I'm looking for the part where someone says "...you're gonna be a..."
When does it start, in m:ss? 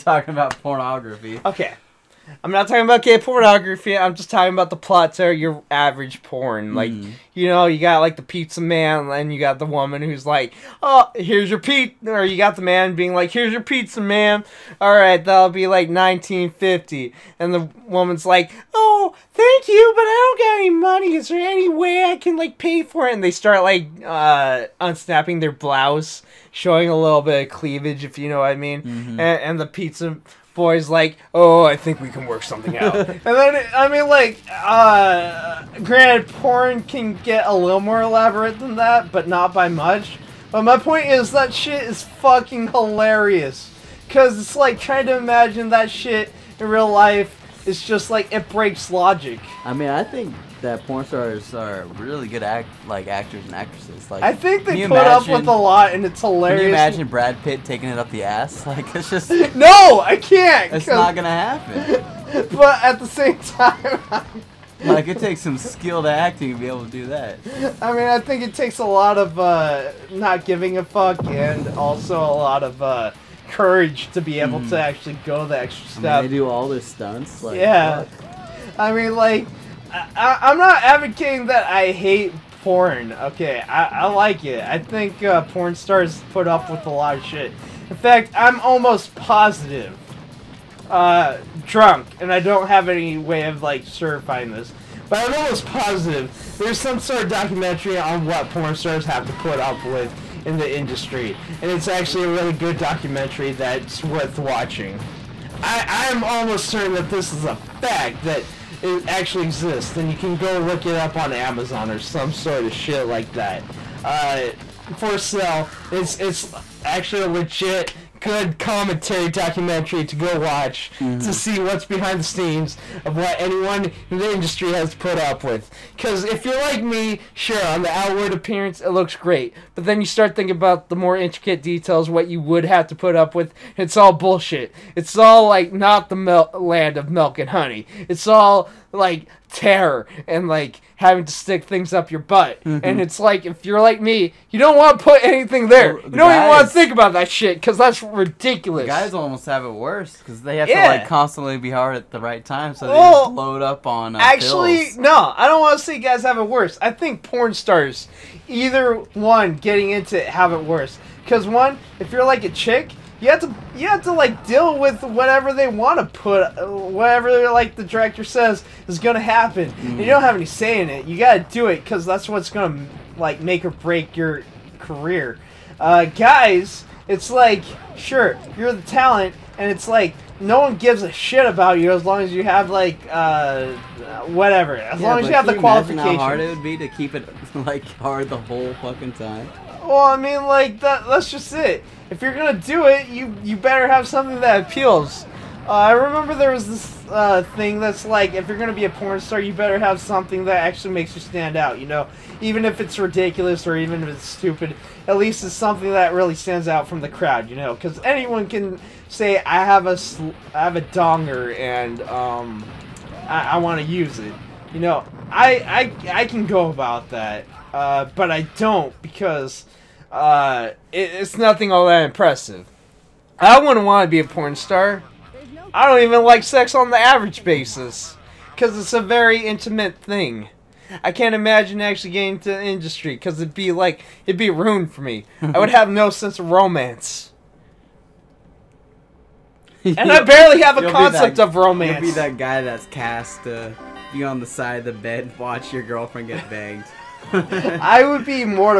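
3:18.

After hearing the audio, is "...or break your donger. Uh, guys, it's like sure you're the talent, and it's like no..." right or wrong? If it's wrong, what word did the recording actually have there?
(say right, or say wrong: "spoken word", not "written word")
wrong: "career", not "donger".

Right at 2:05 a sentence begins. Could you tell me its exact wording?
Because if you're like me, sure, on the outward appearance, it looks great.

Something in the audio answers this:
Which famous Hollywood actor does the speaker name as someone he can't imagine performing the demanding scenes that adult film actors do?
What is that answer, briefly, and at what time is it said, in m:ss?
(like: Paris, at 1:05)
Brad Pitt, at 0:57.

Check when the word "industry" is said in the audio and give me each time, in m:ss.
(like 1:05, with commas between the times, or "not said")
1:40, 2:04, 3:52.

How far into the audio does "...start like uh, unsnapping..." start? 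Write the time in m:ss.
0:23.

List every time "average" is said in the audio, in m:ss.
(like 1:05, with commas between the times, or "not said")
0:05, 3:46.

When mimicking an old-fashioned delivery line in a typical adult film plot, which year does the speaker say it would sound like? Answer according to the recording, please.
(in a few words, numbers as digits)
1950.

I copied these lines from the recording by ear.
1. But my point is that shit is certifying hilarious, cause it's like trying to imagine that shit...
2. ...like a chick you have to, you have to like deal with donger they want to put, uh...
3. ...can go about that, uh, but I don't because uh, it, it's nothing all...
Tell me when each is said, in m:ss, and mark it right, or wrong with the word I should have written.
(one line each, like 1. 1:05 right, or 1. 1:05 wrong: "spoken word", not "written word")
1. 0:40 wrong: "fucking", not "certifying"
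2. 2:42 wrong: "whatever", not "donger"
3. 3:36 right.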